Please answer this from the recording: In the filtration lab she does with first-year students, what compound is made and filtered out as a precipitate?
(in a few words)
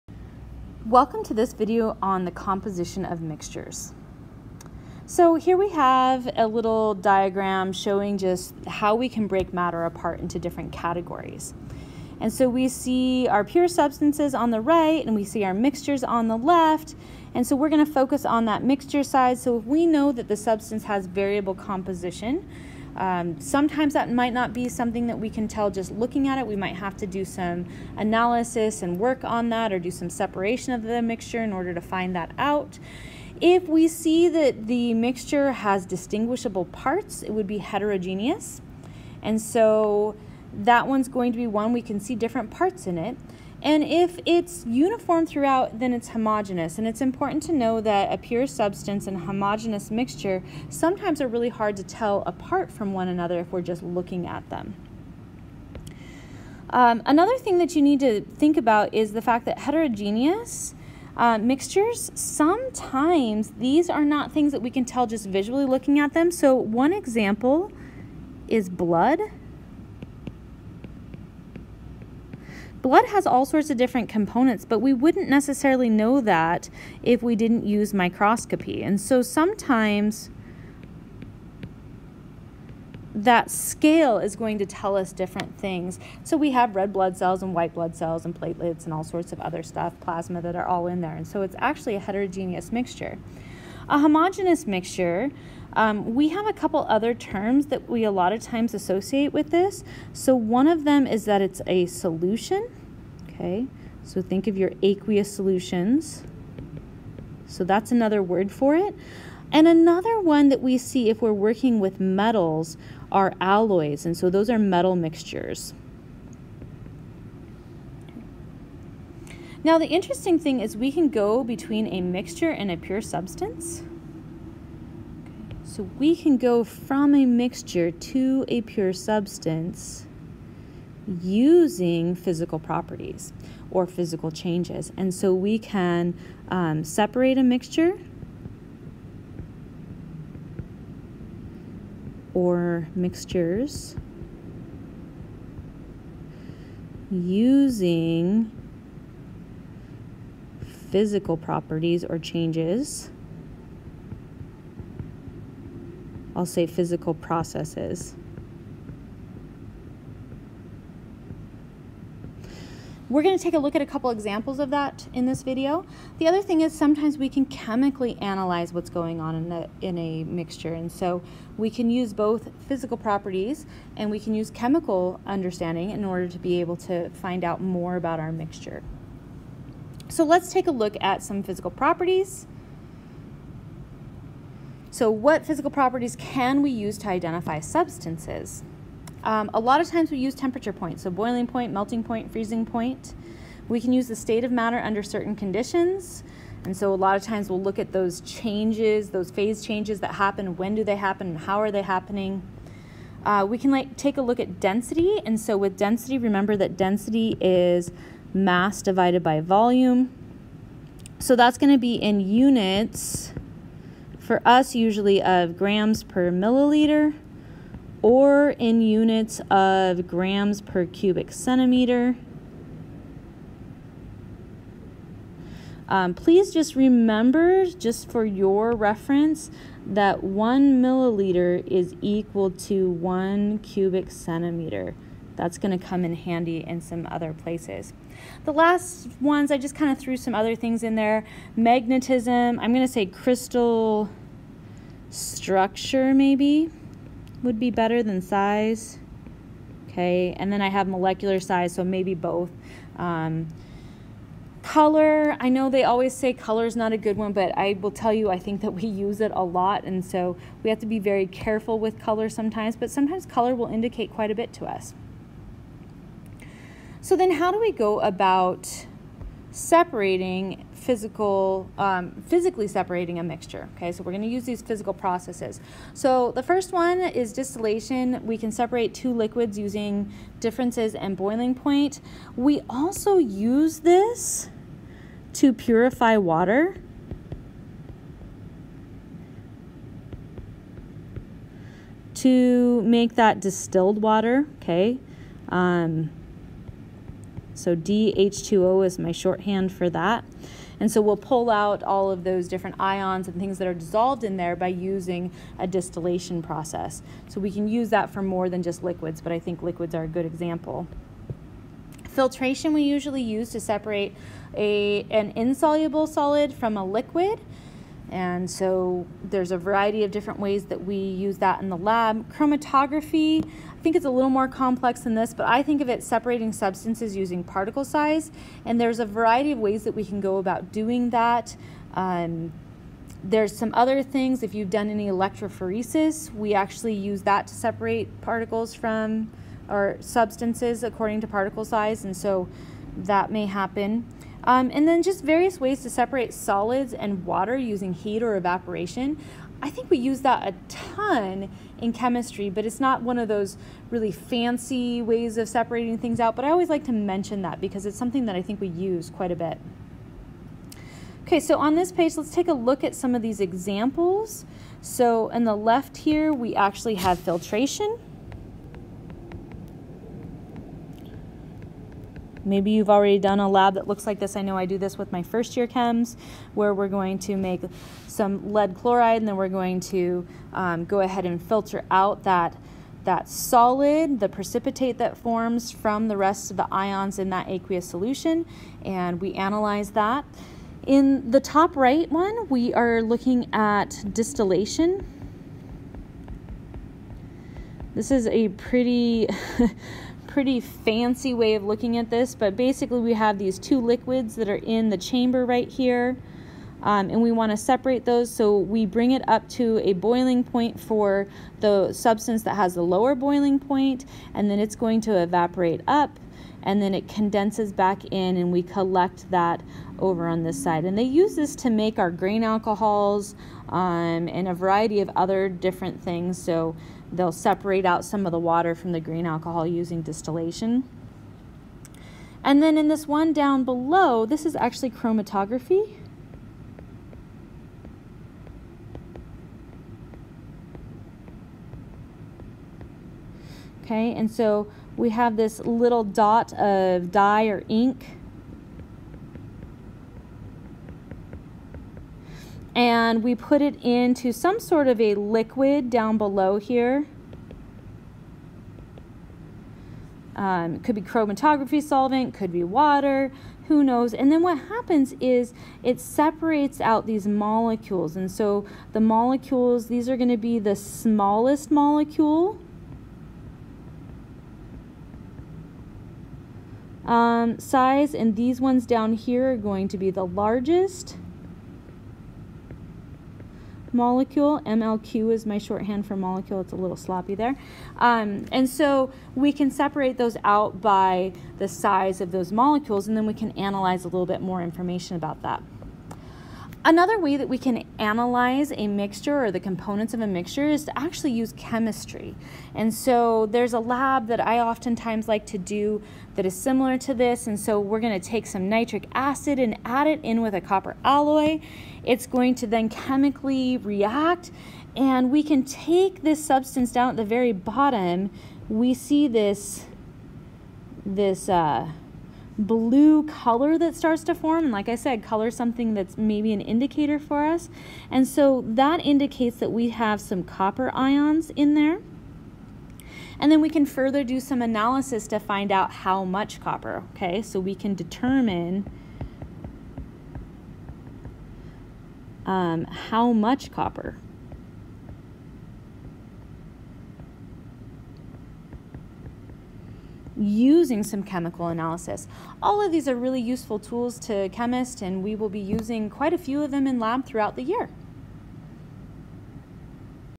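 Lead chloride.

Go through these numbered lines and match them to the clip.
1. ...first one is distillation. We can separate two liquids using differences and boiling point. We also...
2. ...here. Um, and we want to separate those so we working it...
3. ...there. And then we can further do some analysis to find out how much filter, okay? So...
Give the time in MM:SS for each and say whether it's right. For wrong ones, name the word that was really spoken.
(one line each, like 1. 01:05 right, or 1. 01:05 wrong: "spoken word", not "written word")
1. 04:36 right
2. 06:45 wrong: "bring", not "working"
3. 08:51 wrong: "copper", not "filter".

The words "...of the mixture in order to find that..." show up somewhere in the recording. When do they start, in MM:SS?
00:30.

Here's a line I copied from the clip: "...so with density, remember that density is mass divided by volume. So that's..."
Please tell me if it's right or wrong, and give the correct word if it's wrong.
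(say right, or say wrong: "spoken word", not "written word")
right.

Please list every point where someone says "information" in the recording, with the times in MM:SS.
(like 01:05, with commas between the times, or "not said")
08:14.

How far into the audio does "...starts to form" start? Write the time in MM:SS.
08:43.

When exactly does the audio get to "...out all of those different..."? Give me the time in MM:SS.
05:01.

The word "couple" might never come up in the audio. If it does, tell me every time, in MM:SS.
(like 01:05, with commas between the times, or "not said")
01:36, 02:43.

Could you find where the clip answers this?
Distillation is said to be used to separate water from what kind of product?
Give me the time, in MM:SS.
07:02.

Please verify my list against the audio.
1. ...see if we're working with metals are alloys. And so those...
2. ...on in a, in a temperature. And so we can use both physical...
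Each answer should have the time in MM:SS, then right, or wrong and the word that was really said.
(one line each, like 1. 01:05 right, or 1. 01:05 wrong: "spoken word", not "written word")
1. 01:50 right
2. 02:49 wrong: "mixture", not "temperature".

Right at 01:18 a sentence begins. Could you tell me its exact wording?
And so sometimes that scale is going to tell us different things.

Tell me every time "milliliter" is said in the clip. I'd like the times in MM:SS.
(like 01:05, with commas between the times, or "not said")
03:36, 03:50.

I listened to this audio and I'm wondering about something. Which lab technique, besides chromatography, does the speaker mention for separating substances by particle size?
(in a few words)
Electrophoresis.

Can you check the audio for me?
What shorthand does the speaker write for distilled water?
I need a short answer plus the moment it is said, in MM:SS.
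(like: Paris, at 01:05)
DH2O, at 04:57.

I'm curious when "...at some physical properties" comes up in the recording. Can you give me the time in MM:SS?
03:00.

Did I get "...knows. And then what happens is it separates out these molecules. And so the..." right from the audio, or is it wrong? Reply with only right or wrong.
right.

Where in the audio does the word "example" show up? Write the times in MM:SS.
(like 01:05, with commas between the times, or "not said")
01:06, 02:44, 05:10, 06:03.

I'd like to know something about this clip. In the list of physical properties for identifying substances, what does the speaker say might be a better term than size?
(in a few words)
Crystal structure.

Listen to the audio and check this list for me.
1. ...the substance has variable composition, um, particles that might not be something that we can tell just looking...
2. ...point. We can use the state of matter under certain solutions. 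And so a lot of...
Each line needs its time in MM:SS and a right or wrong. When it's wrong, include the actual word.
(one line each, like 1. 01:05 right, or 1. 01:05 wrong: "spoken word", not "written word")
1. 00:20 wrong: "sometimes", not "particles"
2. 03:12 wrong: "conditions", not "solutions".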